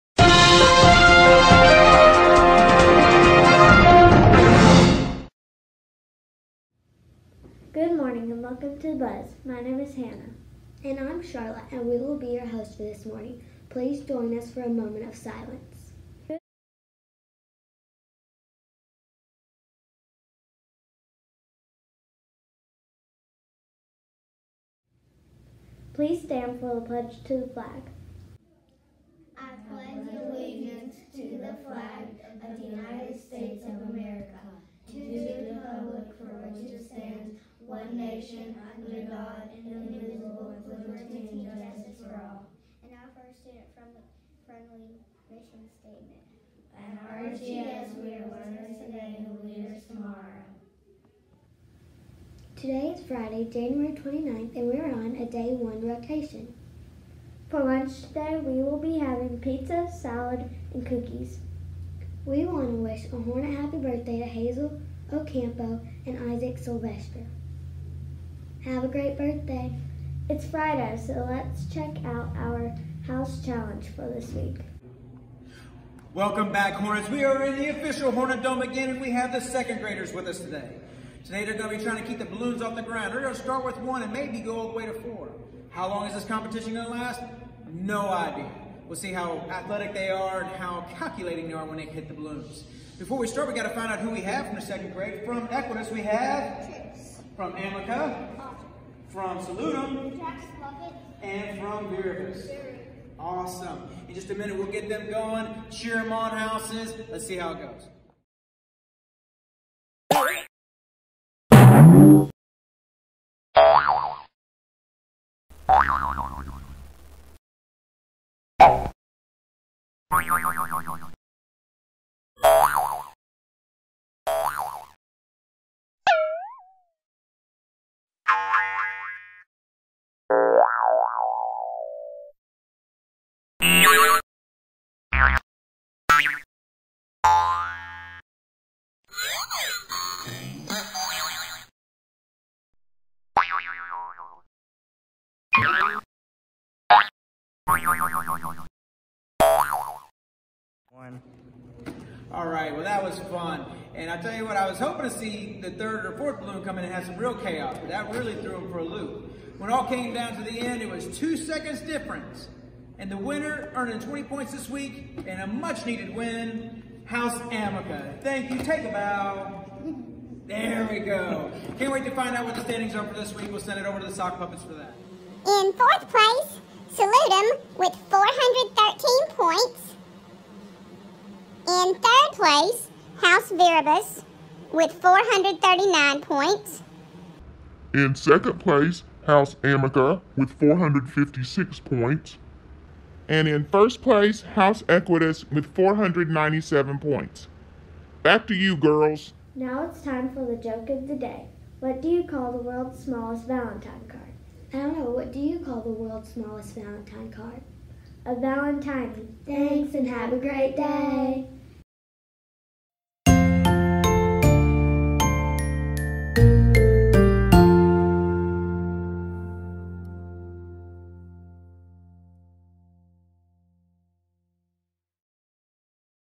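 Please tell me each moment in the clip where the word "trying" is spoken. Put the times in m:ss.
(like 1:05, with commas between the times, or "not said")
1:21.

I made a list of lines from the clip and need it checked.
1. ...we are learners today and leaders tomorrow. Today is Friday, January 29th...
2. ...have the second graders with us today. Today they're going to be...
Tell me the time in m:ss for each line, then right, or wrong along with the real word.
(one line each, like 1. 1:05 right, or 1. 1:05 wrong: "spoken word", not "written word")
1. 0:48 right
2. 1:19 right.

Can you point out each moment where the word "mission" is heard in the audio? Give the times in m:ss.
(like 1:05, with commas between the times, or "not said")
0:45.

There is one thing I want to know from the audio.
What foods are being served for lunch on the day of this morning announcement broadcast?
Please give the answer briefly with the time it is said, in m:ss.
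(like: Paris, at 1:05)
Pizza, salad, and cookies, at 0:59.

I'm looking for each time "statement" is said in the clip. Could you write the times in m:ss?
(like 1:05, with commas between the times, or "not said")
0:45.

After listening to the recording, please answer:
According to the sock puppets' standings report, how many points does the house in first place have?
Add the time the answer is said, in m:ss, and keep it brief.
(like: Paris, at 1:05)
497, at 3:15.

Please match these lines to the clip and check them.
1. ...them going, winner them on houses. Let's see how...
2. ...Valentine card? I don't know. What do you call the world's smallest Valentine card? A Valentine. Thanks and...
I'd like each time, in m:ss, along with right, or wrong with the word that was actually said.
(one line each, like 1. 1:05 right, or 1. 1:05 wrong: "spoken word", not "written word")
1. 1:44 wrong: "cheer", not "winner"
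2. 3:23 right.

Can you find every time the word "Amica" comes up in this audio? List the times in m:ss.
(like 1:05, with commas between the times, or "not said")
1:37, 2:47, 3:09.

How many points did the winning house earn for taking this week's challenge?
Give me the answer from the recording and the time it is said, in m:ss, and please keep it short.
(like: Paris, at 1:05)
20, at 2:43.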